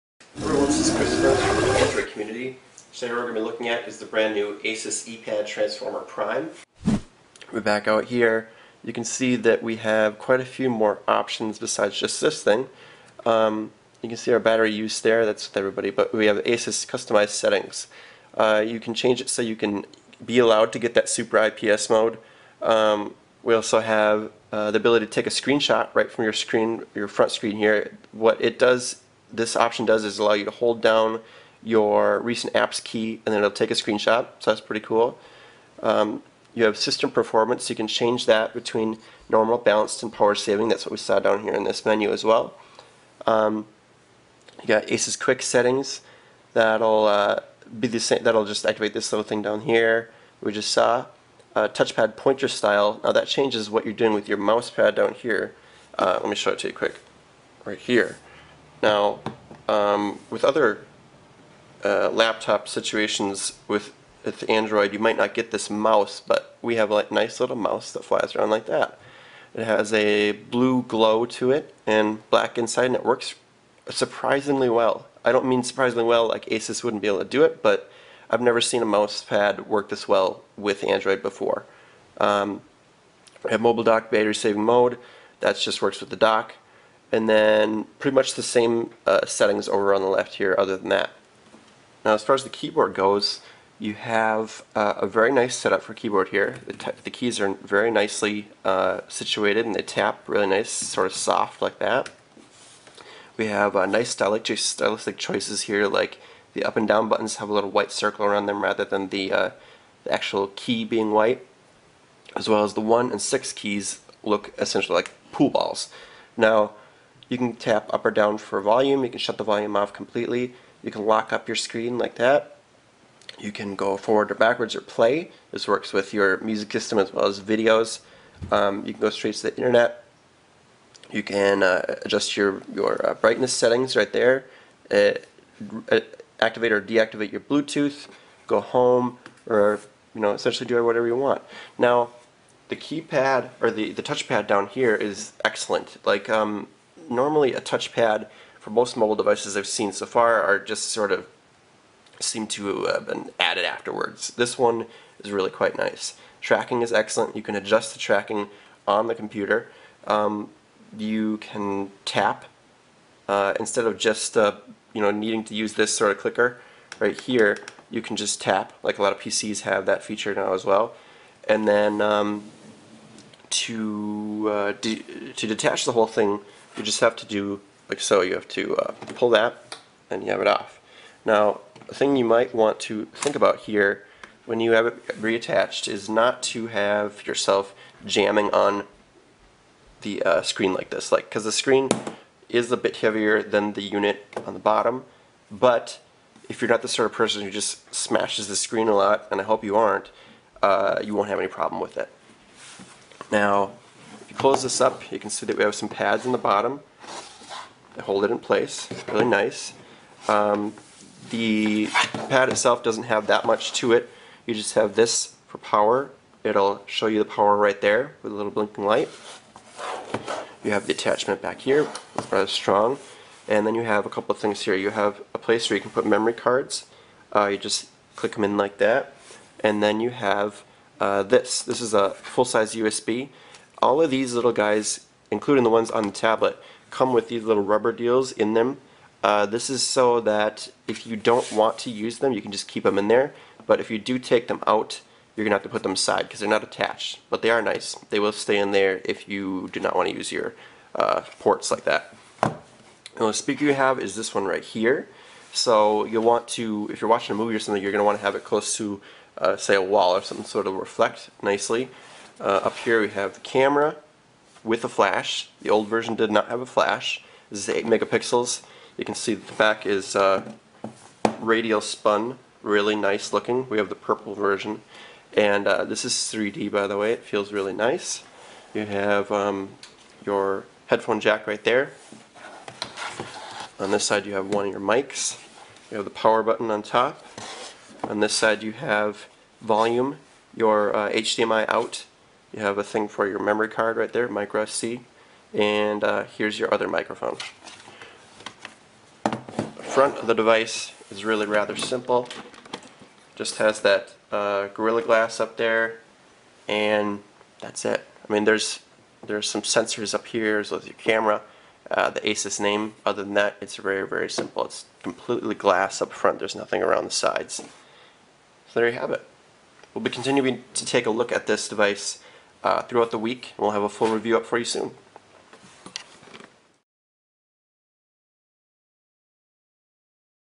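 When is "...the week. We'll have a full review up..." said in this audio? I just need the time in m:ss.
5:23.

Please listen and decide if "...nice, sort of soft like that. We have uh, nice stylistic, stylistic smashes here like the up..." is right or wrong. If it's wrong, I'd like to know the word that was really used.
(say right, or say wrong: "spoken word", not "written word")
wrong: "choices", not "smashes".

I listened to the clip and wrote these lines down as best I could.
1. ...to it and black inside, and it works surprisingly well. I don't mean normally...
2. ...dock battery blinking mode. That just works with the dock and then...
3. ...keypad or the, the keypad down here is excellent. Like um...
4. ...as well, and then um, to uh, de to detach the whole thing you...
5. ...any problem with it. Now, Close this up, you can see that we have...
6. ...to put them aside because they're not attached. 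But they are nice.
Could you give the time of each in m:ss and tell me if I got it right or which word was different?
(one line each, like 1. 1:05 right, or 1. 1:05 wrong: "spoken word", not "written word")
1. 1:11 wrong: "surprisingly", not "normally"
2. 1:23 wrong: "saving", not "blinking"
3. 2:22 wrong: "touchpad", not "keypad"
4. 2:50 right
5. 3:21 right
6. 4:05 right.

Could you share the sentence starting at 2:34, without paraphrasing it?
This one is really quite nice.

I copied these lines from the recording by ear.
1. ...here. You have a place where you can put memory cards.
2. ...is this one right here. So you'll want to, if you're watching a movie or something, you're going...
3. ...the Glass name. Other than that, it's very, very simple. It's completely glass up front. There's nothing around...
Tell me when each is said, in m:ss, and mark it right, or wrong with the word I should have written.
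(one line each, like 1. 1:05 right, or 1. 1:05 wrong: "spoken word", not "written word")
1. 3:44 right
2. 4:13 right
3. 5:12 wrong: "Asus", not "Glass".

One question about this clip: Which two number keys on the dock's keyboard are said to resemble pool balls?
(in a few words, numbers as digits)
1 and 6.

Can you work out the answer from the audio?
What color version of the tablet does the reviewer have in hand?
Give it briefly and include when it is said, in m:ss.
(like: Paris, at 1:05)
Purple, at 4:33.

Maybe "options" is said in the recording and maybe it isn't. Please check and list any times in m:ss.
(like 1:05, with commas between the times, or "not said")
0:11, 0:29.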